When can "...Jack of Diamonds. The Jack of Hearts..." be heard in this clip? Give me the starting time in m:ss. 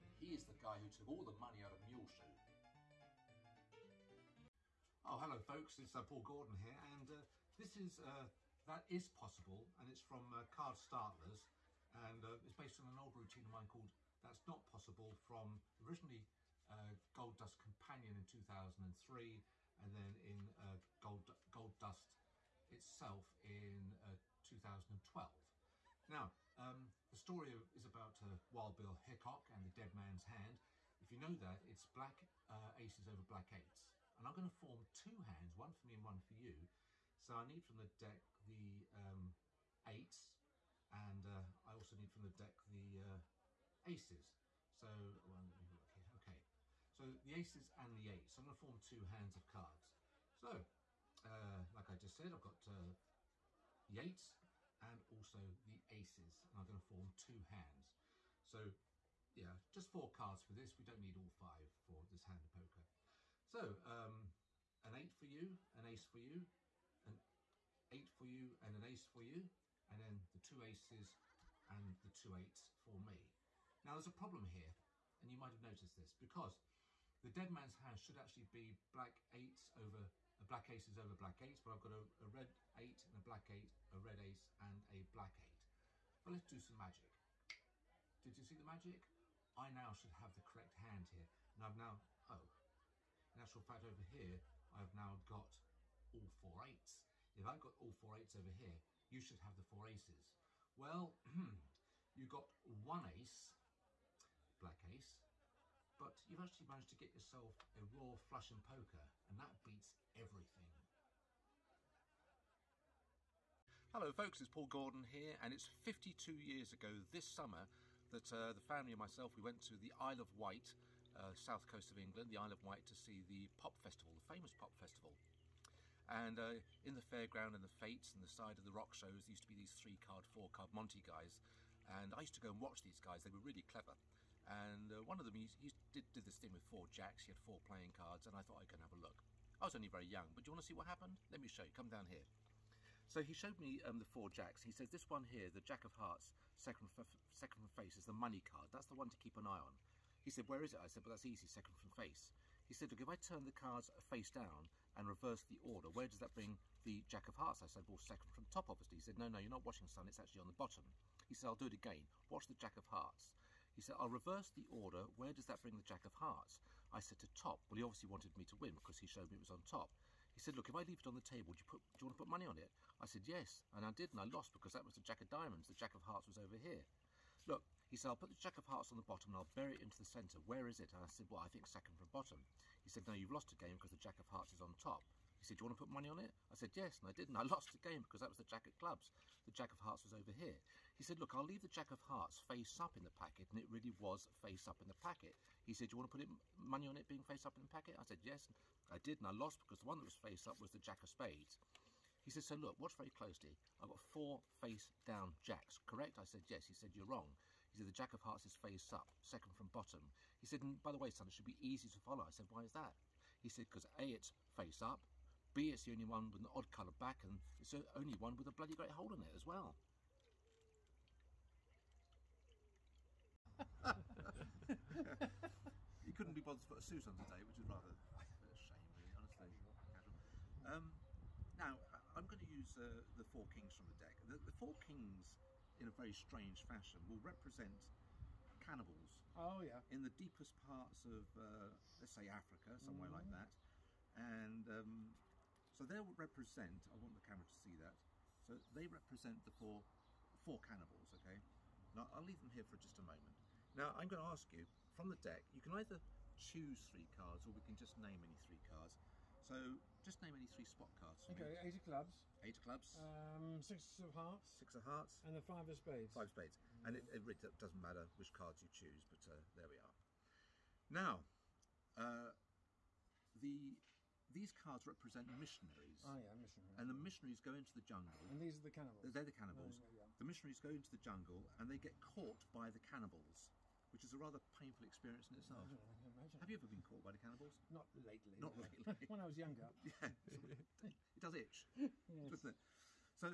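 2:55.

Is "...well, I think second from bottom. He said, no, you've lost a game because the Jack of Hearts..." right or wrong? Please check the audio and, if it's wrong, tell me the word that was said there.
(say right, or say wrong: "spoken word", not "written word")
right.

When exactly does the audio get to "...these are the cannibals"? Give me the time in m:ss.
4:38.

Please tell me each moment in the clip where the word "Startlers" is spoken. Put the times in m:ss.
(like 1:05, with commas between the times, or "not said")
0:10.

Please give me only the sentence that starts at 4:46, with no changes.
Have you ever been caught by the cannibals?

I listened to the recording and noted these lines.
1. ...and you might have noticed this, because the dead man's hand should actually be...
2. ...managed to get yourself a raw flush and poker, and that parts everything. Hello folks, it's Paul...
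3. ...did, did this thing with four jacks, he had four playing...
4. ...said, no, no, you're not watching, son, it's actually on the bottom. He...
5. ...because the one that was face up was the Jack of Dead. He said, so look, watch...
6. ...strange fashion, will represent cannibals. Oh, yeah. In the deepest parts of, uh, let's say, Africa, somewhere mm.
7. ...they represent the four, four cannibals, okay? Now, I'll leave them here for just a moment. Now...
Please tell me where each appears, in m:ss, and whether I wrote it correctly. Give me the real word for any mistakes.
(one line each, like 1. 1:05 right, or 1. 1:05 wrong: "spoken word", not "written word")
1. 1:15 right
2. 1:46 wrong: "beats", not "parts"
3. 2:15 right
4. 2:39 right
5. 3:19 wrong: "Spades", not "Dead"
6. 3:56 right
7. 4:08 right.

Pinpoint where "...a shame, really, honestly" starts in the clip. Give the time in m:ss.
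3:48.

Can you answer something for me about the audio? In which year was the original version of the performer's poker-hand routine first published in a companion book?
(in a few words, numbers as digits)
2003.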